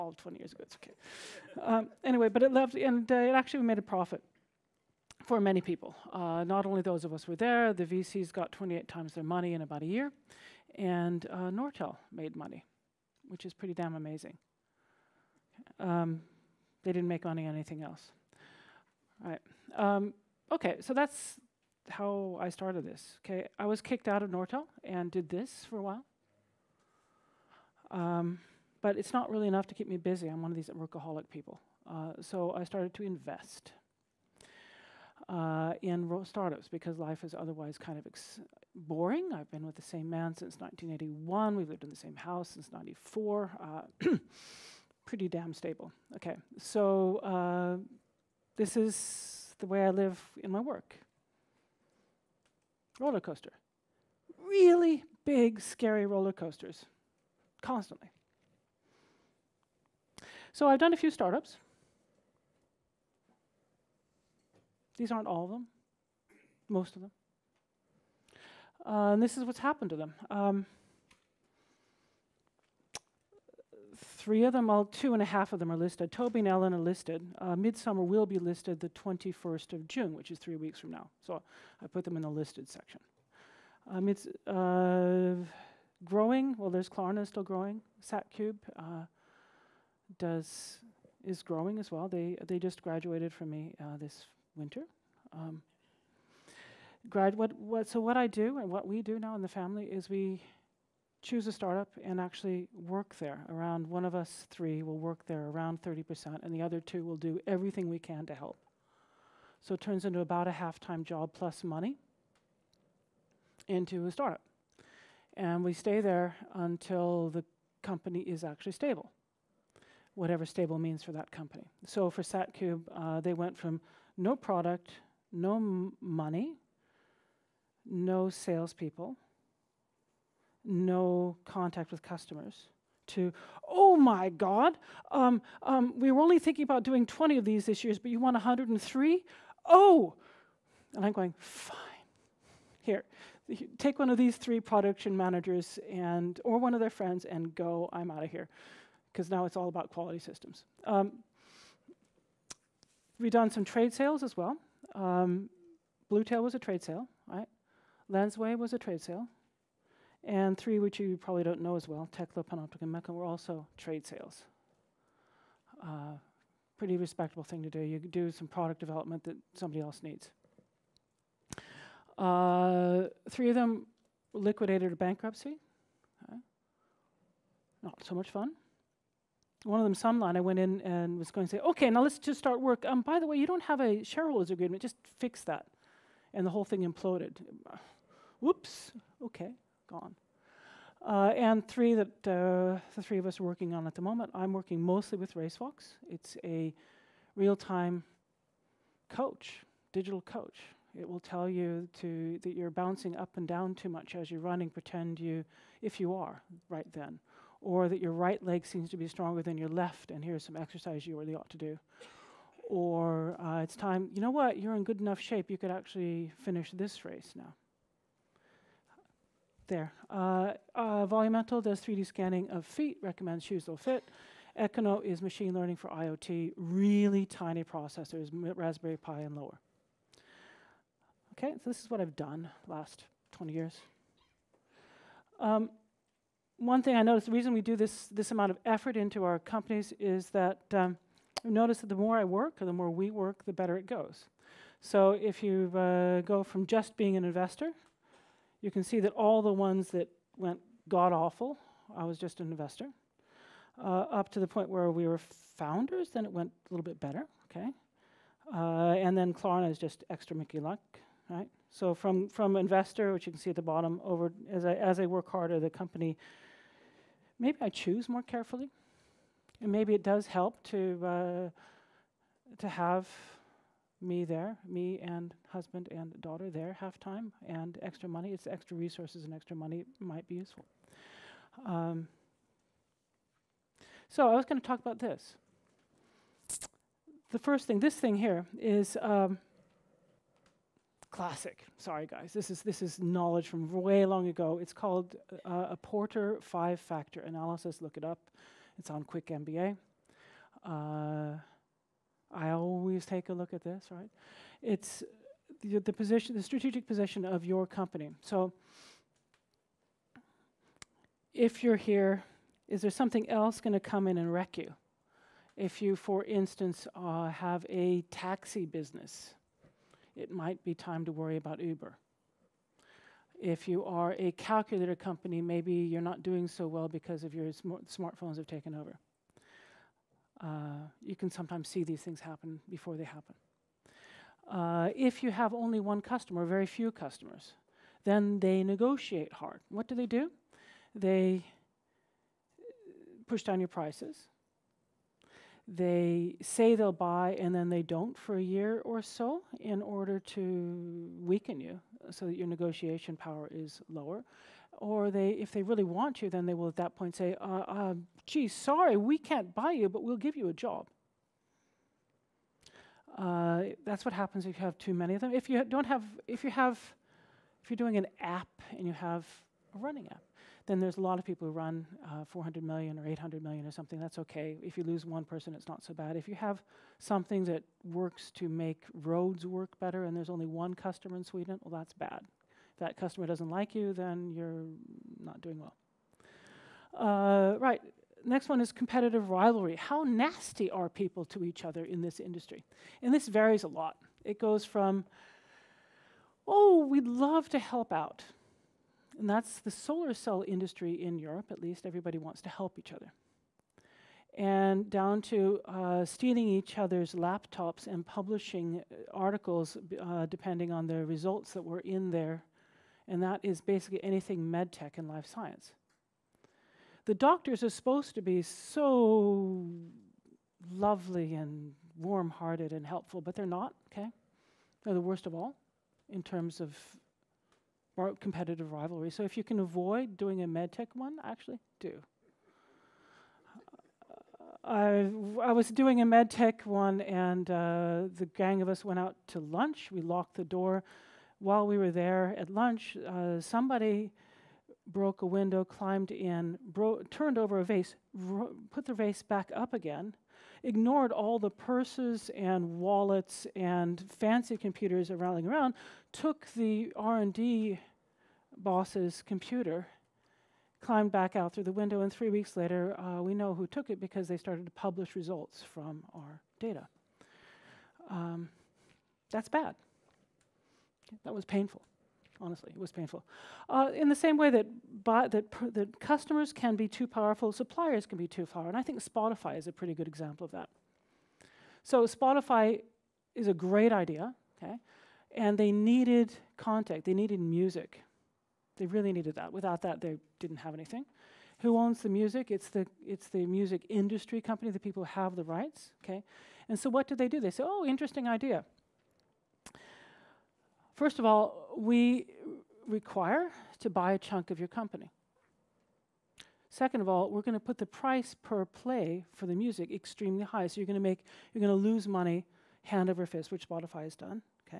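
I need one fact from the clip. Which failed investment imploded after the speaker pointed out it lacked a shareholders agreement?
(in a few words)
Sunline.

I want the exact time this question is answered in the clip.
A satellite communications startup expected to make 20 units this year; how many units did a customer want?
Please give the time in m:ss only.
2:18.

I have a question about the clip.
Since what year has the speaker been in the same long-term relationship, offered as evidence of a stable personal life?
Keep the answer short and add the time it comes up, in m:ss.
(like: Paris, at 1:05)
1981, at 0:40.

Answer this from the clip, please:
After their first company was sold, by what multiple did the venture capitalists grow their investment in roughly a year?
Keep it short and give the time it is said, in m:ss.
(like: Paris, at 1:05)
28 times, at 0:08.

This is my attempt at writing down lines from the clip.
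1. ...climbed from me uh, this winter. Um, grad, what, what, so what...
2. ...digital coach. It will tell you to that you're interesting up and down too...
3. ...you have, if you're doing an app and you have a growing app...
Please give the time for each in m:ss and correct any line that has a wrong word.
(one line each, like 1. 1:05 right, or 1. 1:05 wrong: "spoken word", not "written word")
1. 1:32 wrong: "graduated", not "climbed"
2. 3:19 wrong: "bouncing", not "interesting"
3. 6:06 wrong: "running", not "growing".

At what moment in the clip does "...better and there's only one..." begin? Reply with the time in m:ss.
6:19.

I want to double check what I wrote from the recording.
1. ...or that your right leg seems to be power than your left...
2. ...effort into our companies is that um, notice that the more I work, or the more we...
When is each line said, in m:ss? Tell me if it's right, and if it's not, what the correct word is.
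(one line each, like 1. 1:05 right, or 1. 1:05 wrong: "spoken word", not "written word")
1. 3:27 wrong: "stronger", not "power"
2. 3:58 right.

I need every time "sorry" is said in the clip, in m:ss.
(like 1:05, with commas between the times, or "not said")
4:51, 5:58.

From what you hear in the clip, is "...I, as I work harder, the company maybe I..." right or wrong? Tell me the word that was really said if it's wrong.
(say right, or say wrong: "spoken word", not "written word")
right.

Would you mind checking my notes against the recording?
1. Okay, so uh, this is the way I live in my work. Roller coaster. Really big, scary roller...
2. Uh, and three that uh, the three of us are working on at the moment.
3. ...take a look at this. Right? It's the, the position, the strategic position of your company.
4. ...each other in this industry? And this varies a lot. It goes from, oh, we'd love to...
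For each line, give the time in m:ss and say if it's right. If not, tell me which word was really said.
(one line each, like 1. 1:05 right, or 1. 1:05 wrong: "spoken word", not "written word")
1. 0:46 right
2. 3:11 right
3. 5:03 right
4. 6:31 right.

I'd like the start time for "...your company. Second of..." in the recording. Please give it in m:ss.
8:24.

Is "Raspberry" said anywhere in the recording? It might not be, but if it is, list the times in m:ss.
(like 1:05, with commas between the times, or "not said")
3:48.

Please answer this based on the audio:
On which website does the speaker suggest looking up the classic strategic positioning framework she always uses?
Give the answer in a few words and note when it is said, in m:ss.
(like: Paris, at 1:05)
Quick MBA, at 4:59.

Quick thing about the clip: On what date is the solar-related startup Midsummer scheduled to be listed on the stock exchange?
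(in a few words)
21st of June.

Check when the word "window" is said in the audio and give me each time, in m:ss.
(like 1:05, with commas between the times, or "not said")
7:25, 7:41.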